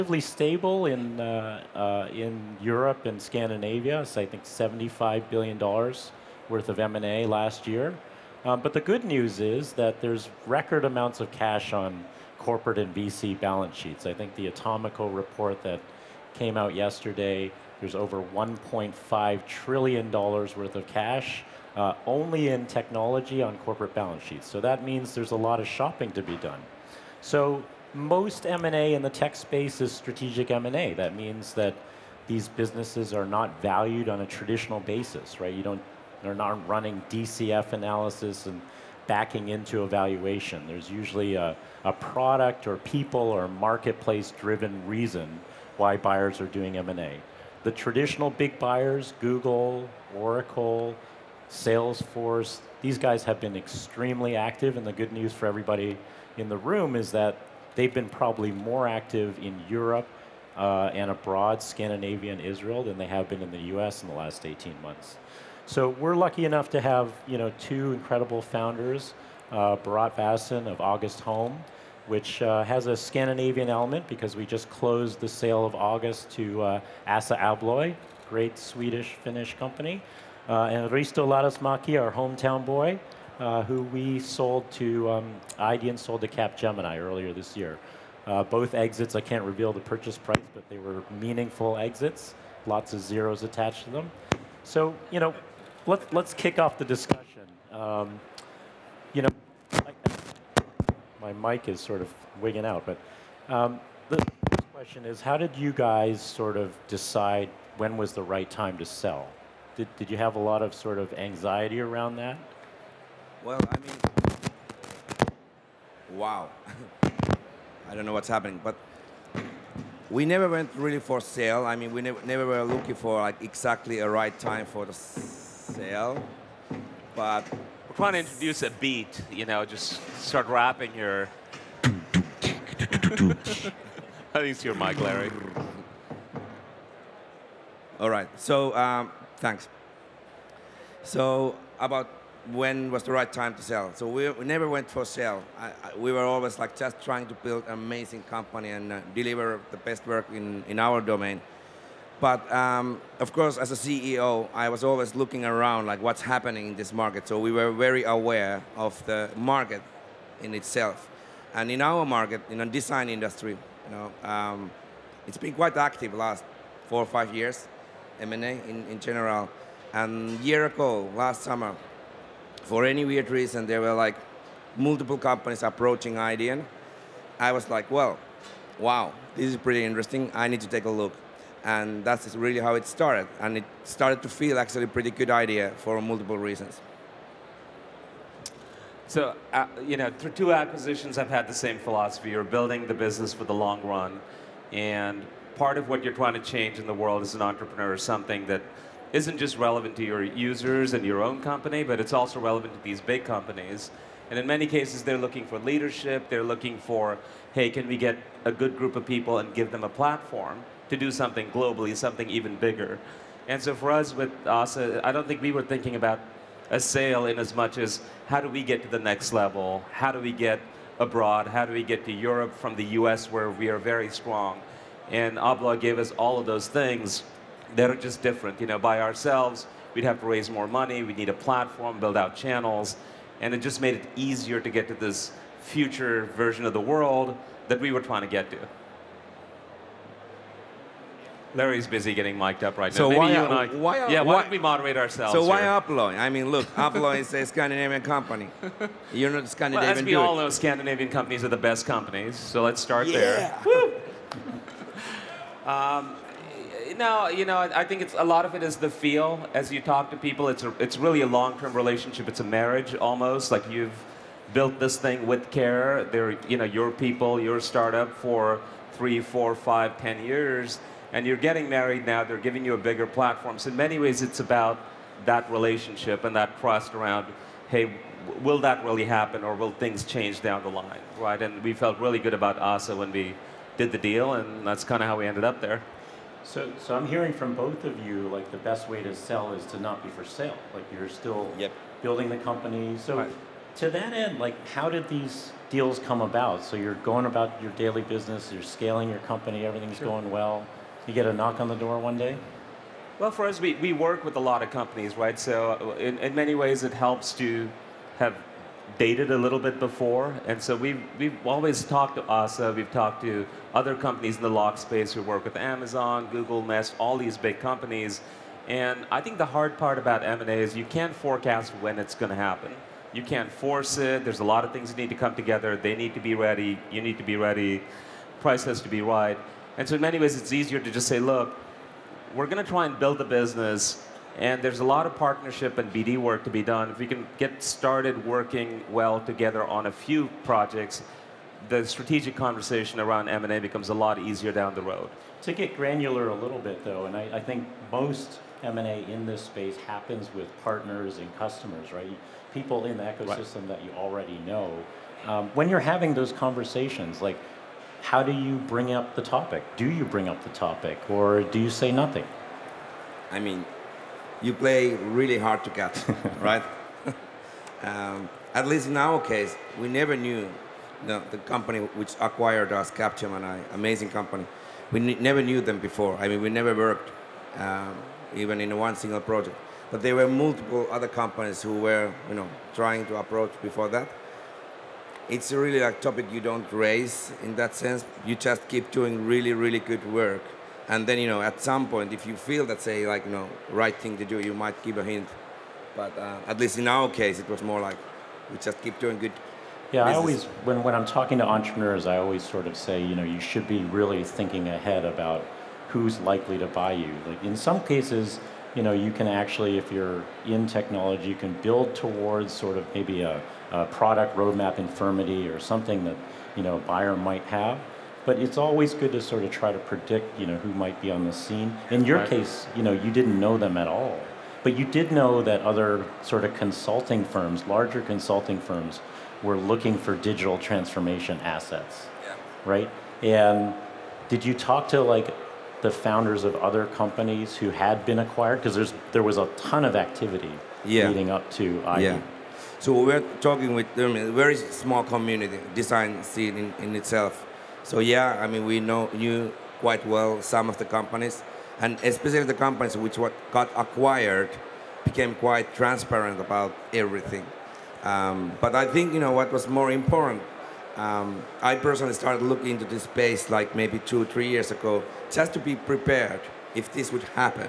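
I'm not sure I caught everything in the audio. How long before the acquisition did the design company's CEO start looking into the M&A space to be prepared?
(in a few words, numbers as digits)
2 or 3 years.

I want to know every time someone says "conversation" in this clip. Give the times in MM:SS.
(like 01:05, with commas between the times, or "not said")
05:42, 05:56.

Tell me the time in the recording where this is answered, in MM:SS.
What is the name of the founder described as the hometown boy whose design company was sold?
01:20.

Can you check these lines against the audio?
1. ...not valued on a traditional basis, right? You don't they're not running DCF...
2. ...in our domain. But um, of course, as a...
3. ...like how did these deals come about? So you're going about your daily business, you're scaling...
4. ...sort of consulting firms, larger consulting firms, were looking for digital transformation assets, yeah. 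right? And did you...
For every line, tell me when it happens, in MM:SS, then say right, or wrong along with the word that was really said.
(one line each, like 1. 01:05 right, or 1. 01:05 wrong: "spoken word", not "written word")
1. 00:33 right
2. 02:30 right
3. 04:54 right
4. 07:06 right.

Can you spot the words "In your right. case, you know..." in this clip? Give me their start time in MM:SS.
07:01.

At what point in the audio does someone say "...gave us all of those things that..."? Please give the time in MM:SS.
03:45.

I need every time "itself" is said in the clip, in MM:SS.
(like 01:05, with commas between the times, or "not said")
02:40, 07:26.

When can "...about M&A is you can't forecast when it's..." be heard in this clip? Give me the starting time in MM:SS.
05:19.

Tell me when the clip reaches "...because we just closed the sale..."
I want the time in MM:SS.
01:14.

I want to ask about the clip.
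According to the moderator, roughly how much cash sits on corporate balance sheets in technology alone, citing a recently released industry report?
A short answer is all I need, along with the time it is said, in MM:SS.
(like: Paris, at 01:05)
$1.5 trillion, at 00:18.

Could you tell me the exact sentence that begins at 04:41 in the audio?
And we felt really good about Assa when we did the deal, and that's kind of how we ended up there.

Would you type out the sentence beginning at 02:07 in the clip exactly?
But we're trying to introduce a beat, you know, just start rapping your.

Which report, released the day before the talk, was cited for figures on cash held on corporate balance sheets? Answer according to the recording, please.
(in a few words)
Atomico report.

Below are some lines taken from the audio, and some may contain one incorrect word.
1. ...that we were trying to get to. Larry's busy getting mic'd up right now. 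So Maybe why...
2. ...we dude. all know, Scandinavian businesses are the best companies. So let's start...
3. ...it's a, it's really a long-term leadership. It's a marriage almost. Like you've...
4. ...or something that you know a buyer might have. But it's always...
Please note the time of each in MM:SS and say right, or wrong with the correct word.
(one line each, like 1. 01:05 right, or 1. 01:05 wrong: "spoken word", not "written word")
1. 03:57 right
2. 04:10 wrong: "companies", not "businesses"
3. 04:20 wrong: "relationship", not "leadership"
4. 06:55 right.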